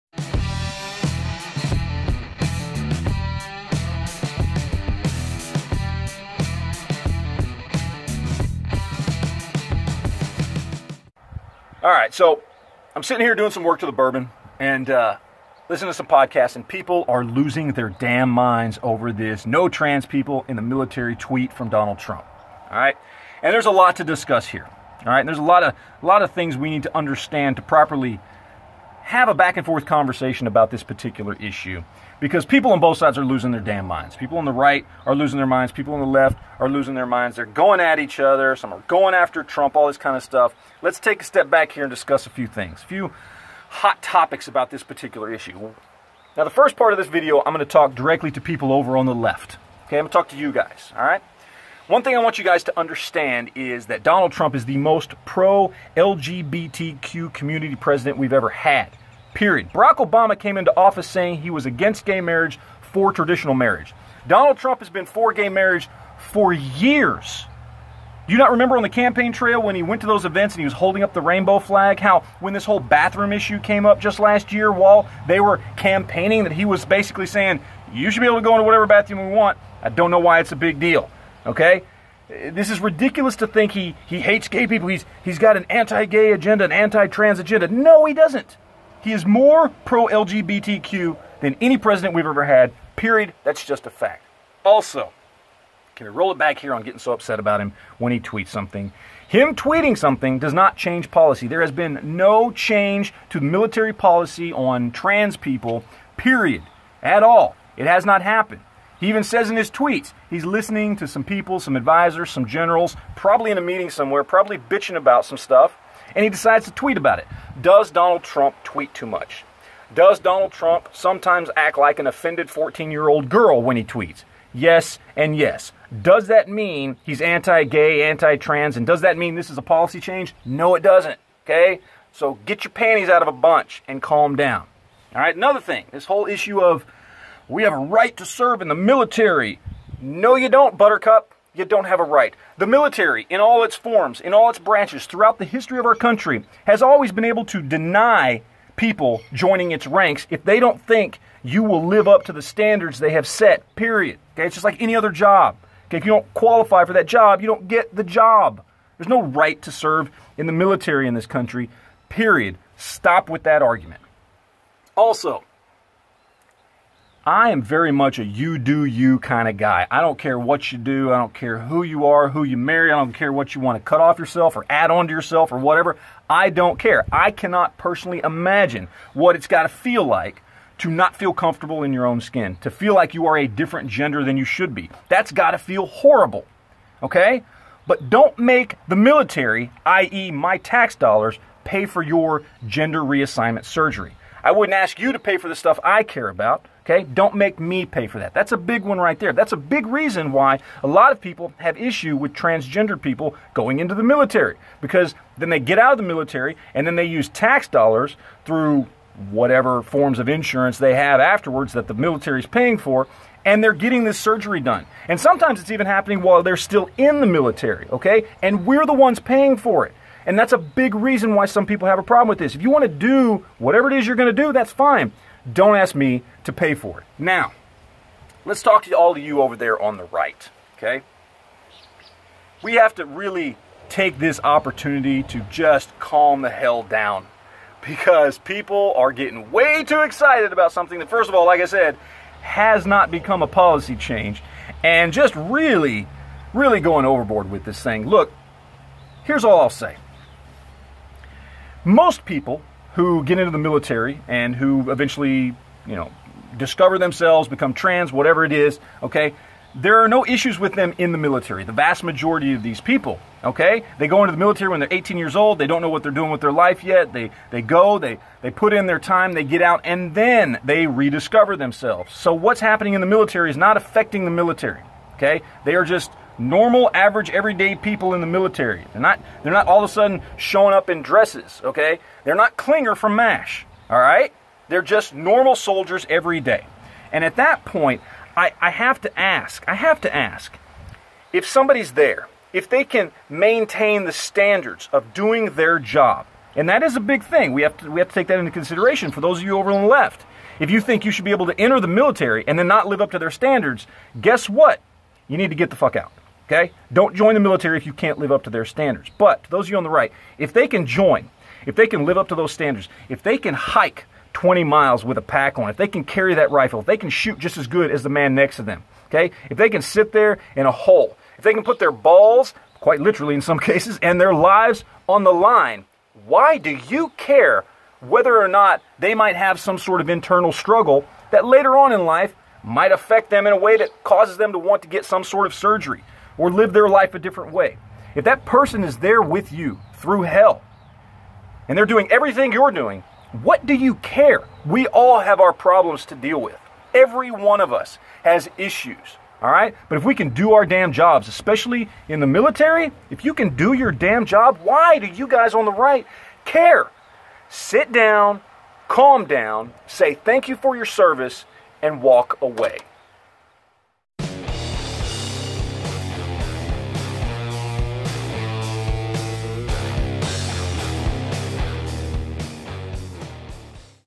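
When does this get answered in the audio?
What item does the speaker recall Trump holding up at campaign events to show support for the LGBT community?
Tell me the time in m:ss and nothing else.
1:11.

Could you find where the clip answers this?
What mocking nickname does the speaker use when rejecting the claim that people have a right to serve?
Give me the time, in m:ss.
2:20.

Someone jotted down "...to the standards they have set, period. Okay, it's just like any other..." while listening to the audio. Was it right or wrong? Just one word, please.
right.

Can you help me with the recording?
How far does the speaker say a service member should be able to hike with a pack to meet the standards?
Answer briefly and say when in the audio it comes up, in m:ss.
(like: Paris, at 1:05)
20 miles, at 5:14.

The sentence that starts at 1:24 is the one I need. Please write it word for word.
He's, he's got an anti gay agenda, an anti trans agenda.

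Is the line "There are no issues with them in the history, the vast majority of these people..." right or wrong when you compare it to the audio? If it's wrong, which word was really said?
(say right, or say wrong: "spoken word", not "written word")
wrong: "military", not "history".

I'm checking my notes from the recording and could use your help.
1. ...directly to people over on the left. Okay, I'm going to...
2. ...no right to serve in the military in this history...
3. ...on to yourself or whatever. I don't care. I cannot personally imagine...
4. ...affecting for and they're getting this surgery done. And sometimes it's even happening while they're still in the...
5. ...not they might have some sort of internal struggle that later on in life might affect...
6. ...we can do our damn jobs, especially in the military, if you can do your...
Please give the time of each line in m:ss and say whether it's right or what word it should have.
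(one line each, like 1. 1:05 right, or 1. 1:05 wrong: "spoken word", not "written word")
1. 0:47 right
2. 2:39 wrong: "country", not "history"
3. 2:54 right
4. 3:32 wrong: "paying", not "affecting"
5. 5:28 right
6. 5:50 right.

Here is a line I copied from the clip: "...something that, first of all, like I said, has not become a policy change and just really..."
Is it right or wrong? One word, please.
right.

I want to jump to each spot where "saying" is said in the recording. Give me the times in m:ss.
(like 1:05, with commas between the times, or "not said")
1:01, 1:17.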